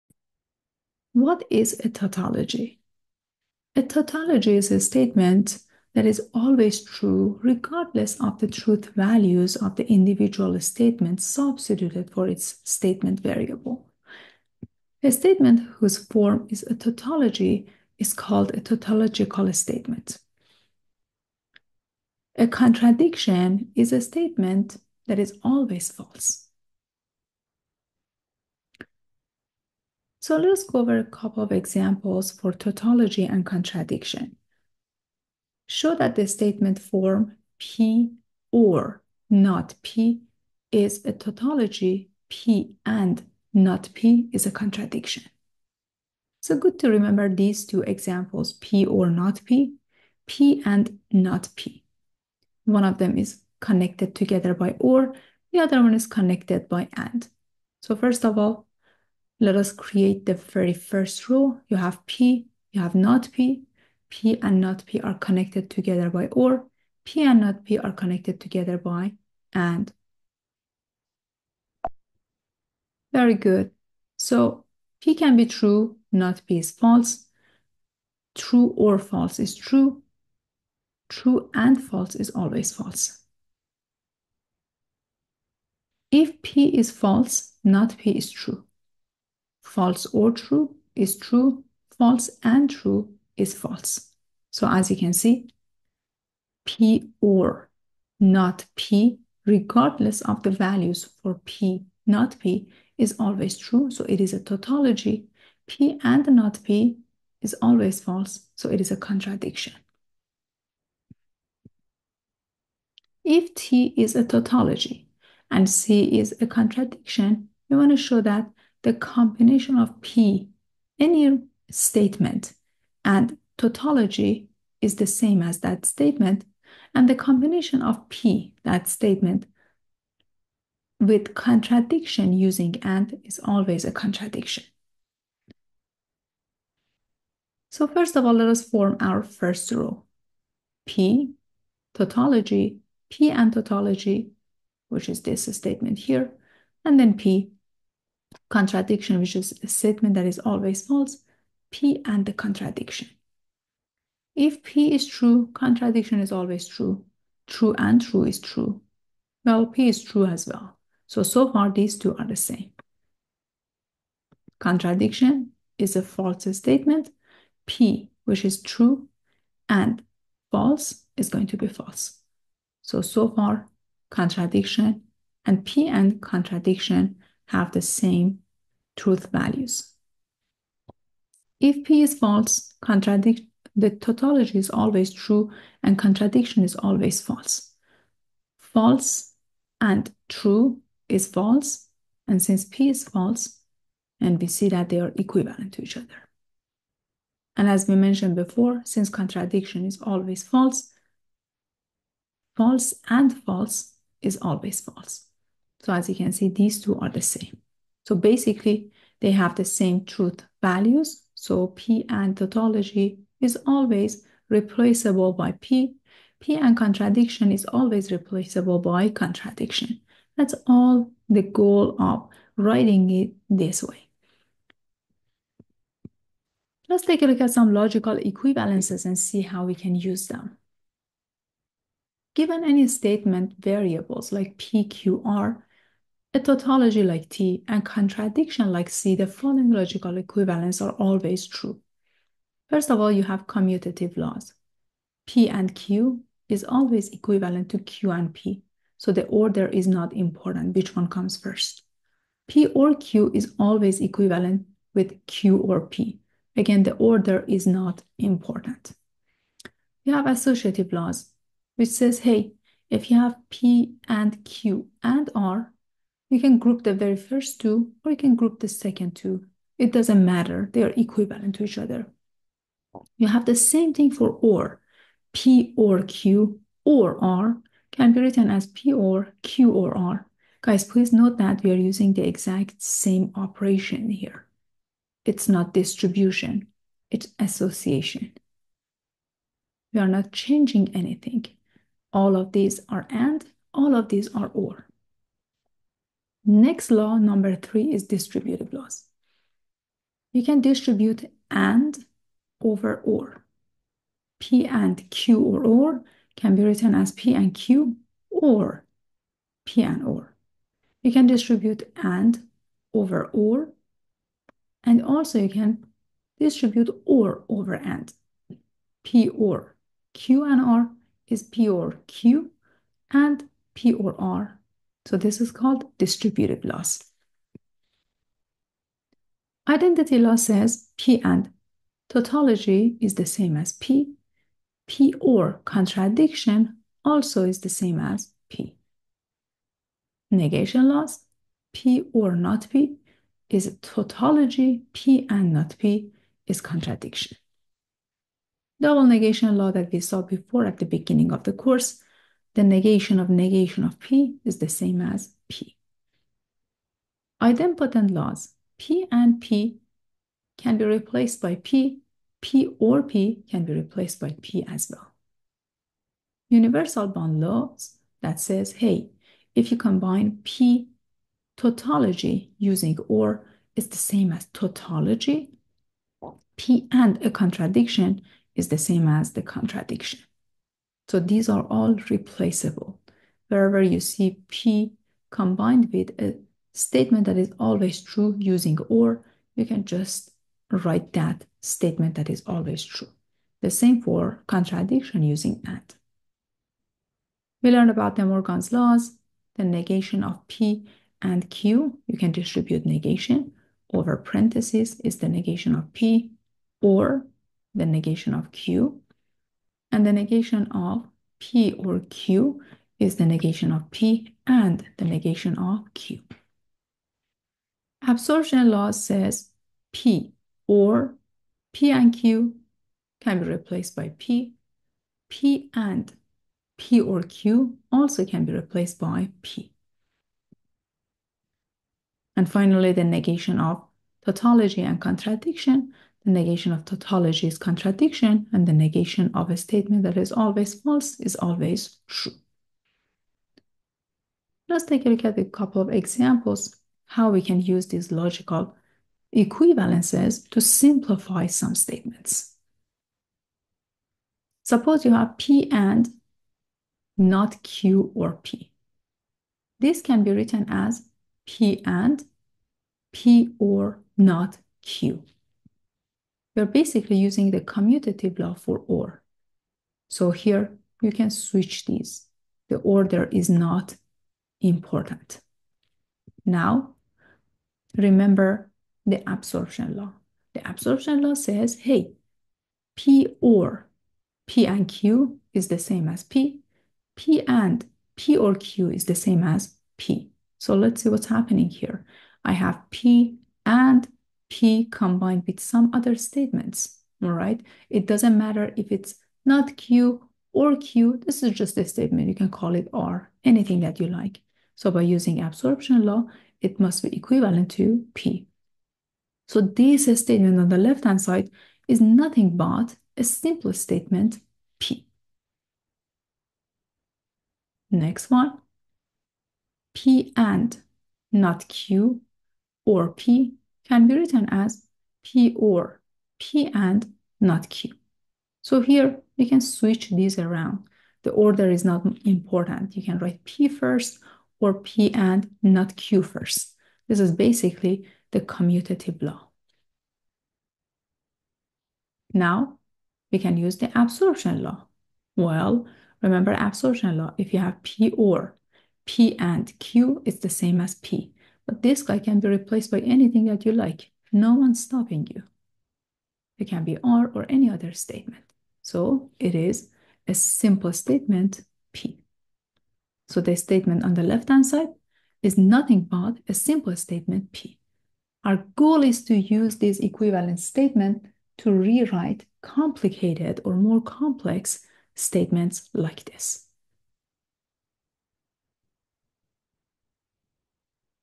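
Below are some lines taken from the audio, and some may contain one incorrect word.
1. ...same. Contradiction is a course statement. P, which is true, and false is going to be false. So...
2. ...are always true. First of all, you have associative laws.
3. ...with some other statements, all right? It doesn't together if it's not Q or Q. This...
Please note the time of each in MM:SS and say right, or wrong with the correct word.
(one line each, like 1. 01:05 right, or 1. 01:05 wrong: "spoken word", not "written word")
1. 02:42 wrong: "false", not "course"
2. 04:00 wrong: "commutative", not "associative"
3. 08:15 wrong: "matter", not "together".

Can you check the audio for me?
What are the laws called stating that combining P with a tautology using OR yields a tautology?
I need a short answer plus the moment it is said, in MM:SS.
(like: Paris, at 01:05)
Universal bound laws, at 06:06.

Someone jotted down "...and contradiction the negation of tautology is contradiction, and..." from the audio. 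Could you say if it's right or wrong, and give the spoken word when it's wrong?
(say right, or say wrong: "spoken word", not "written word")
right.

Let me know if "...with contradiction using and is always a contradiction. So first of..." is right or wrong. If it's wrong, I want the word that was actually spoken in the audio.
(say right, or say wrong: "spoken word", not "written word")
right.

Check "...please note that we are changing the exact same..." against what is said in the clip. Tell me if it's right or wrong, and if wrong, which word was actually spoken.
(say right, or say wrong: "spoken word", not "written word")
wrong: "using", not "changing".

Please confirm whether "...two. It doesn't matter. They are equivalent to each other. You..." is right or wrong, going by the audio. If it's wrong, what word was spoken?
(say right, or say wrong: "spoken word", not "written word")
right.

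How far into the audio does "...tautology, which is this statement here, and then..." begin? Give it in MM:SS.
02:23.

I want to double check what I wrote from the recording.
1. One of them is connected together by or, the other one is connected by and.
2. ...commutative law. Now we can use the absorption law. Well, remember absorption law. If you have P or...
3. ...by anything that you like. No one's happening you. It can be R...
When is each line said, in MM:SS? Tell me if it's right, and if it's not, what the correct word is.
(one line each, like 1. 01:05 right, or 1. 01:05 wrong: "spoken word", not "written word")
1. 00:52 right
2. 08:58 right
3. 09:12 wrong: "stopping", not "happening".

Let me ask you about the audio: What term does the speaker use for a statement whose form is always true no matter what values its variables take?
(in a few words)
tautological statement.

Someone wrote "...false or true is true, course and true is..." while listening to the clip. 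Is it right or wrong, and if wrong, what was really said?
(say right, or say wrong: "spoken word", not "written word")
wrong: "false", not "course".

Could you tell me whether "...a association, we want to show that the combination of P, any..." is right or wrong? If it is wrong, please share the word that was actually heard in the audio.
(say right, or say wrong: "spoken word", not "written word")
wrong: "contradiction", not "association".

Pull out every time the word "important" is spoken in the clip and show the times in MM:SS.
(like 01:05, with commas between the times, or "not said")
04:10, 04:18, 07:54, 08:52.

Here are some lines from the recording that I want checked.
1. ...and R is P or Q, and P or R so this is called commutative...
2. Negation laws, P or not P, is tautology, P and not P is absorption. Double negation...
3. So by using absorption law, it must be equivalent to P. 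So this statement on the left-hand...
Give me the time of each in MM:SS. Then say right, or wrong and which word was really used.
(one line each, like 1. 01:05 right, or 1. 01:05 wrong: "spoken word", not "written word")
1. 05:20 wrong: "distributive", not "commutative"
2. 05:40 wrong: "contradiction", not "absorption"
3. 08:24 right.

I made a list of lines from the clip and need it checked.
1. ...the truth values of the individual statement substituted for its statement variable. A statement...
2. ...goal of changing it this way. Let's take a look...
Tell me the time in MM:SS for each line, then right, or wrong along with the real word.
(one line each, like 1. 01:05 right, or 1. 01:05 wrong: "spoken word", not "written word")
1. 00:08 right
2. 03:41 wrong: "writing", not "changing".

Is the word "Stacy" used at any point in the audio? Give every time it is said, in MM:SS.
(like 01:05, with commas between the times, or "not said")
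not said.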